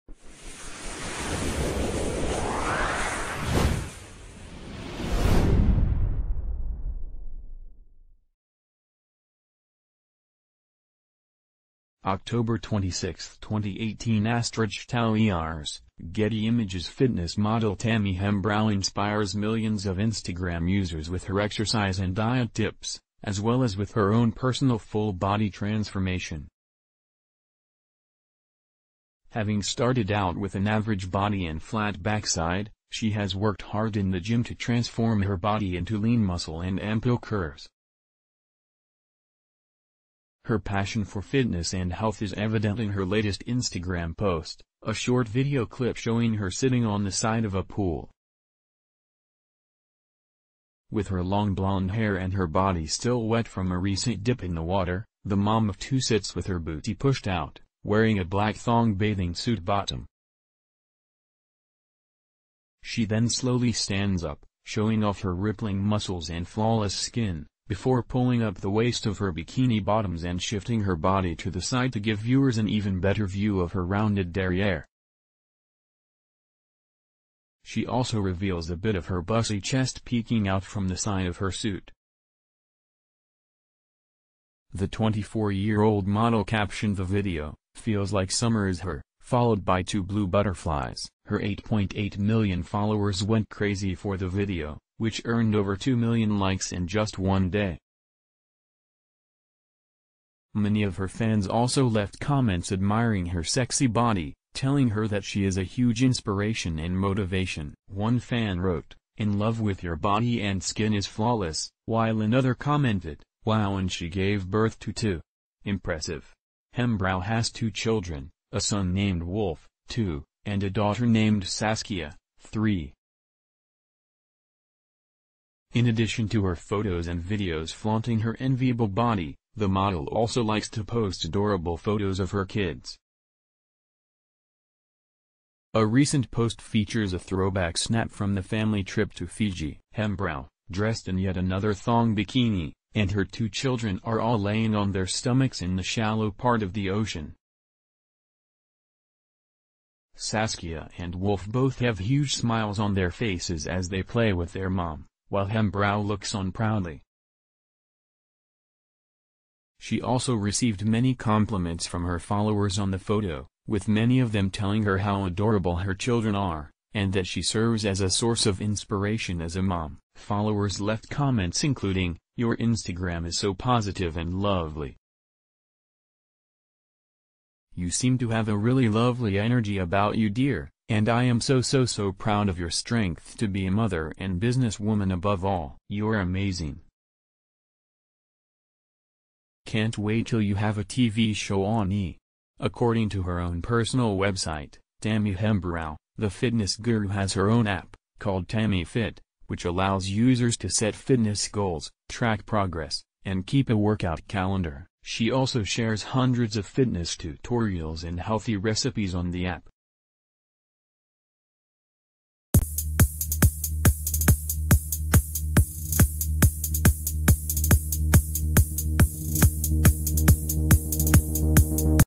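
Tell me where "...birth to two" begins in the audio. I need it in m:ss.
1:54.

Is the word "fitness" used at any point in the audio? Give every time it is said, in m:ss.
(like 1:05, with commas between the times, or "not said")
0:16, 0:41, 3:16, 3:20, 3:26.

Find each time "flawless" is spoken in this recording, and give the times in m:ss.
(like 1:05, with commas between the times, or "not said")
1:06, 1:51.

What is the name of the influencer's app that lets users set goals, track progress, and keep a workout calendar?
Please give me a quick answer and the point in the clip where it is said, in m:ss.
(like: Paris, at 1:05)
Tammy Fit, at 3:18.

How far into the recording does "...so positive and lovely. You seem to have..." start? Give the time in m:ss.
2:53.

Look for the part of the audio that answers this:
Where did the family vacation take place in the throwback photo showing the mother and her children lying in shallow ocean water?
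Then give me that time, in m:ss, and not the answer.
2:19.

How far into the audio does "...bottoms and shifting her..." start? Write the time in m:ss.
1:09.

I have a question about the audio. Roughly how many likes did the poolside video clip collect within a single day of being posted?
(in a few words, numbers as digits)
over 2 million.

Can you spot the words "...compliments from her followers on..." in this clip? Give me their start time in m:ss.
2:41.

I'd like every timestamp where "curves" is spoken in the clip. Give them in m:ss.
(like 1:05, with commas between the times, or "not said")
0:37.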